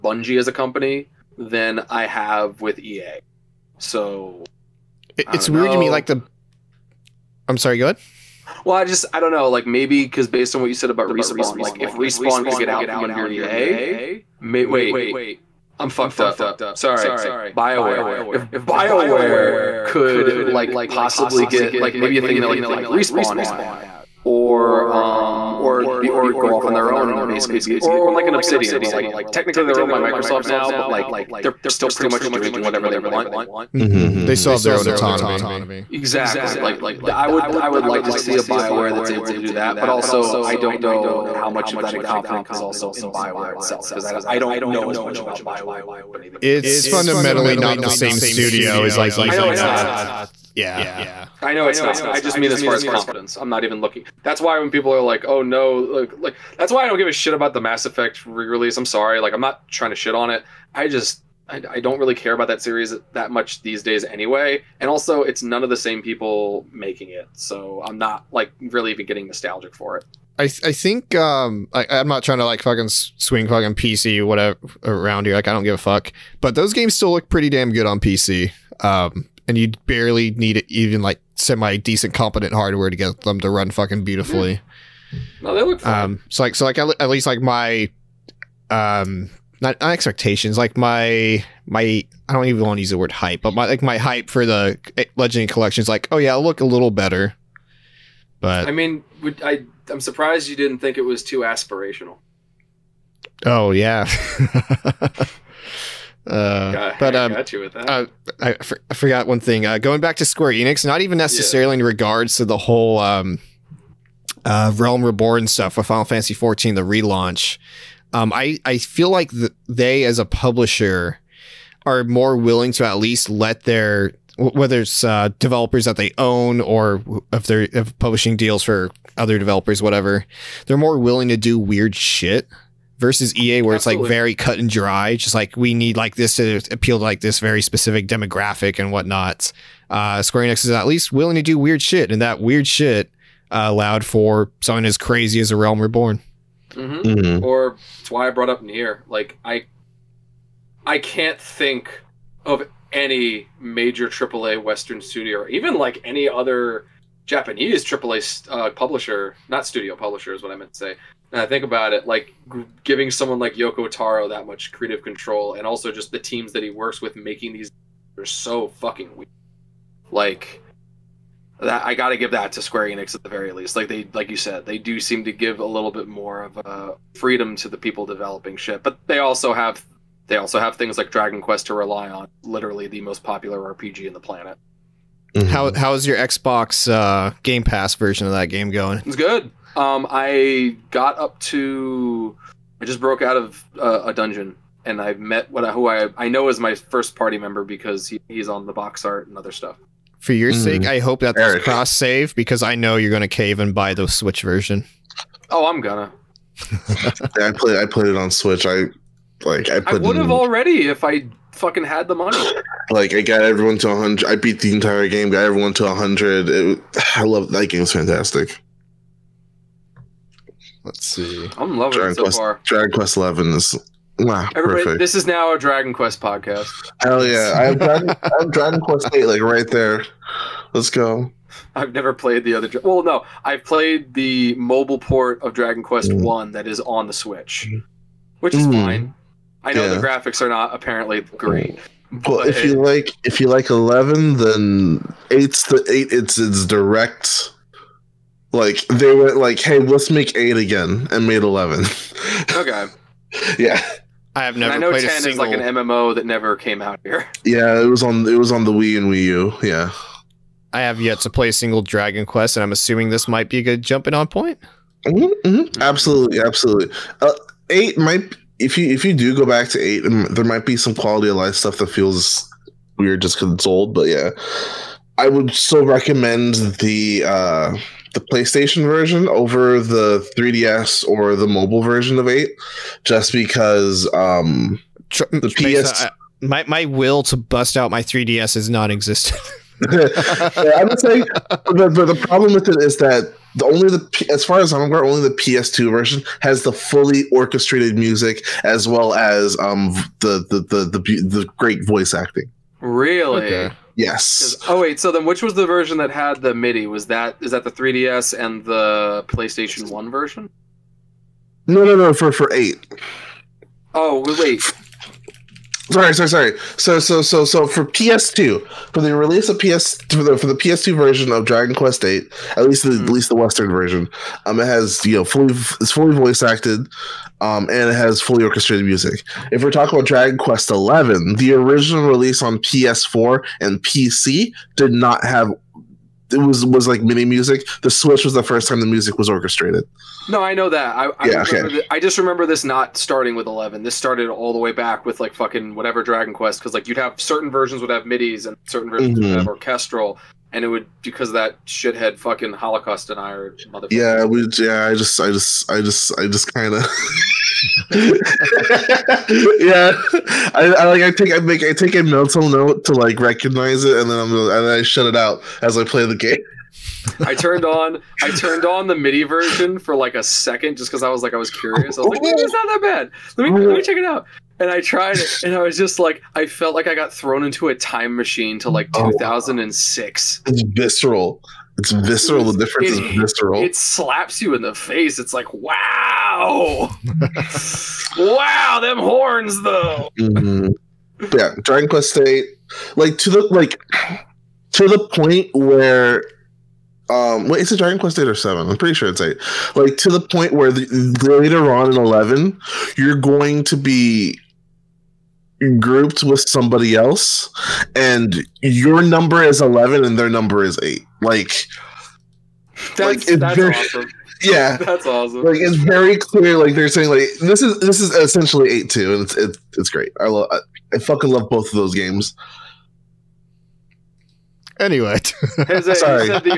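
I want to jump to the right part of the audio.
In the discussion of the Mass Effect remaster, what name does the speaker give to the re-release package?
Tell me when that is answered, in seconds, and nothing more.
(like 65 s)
95 s.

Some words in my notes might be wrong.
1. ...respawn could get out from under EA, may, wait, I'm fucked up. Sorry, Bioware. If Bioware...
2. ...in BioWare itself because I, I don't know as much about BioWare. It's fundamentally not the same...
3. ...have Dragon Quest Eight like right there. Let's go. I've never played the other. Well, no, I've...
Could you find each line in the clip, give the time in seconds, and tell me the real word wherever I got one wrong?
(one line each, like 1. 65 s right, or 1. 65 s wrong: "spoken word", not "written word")
1. 11 s right
2. 42 s right
3. 228 s right.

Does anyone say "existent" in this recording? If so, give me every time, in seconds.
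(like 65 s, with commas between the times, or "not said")
288 s.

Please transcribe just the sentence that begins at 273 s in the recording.
But yeah, I would still recommend the.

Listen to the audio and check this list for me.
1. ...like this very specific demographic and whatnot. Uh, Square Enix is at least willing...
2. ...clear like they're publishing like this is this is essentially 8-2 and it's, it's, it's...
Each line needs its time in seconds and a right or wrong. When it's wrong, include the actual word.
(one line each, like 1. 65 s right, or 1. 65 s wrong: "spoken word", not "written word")
1. 137 s right
2. 416 s wrong: "saying", not "publishing".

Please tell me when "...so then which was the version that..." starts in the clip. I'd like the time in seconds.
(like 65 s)
305 s.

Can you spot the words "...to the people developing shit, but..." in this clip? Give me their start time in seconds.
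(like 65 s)
177 s.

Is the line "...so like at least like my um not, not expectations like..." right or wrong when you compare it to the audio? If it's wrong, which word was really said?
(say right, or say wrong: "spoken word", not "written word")
right.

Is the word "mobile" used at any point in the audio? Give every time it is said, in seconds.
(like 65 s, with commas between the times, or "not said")
234 s, 281 s.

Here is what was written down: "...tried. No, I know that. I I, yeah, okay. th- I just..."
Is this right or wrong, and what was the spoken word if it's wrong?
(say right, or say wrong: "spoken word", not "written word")
wrong: "orchestrated", not "tried".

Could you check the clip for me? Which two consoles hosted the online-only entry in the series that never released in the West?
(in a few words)
Wii and Wii U.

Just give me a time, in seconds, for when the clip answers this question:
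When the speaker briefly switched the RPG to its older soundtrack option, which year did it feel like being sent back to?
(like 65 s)
378 s.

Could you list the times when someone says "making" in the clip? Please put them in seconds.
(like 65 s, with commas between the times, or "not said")
66 s, 167 s.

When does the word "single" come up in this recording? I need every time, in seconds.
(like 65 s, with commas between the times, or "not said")
255 s, 261 s.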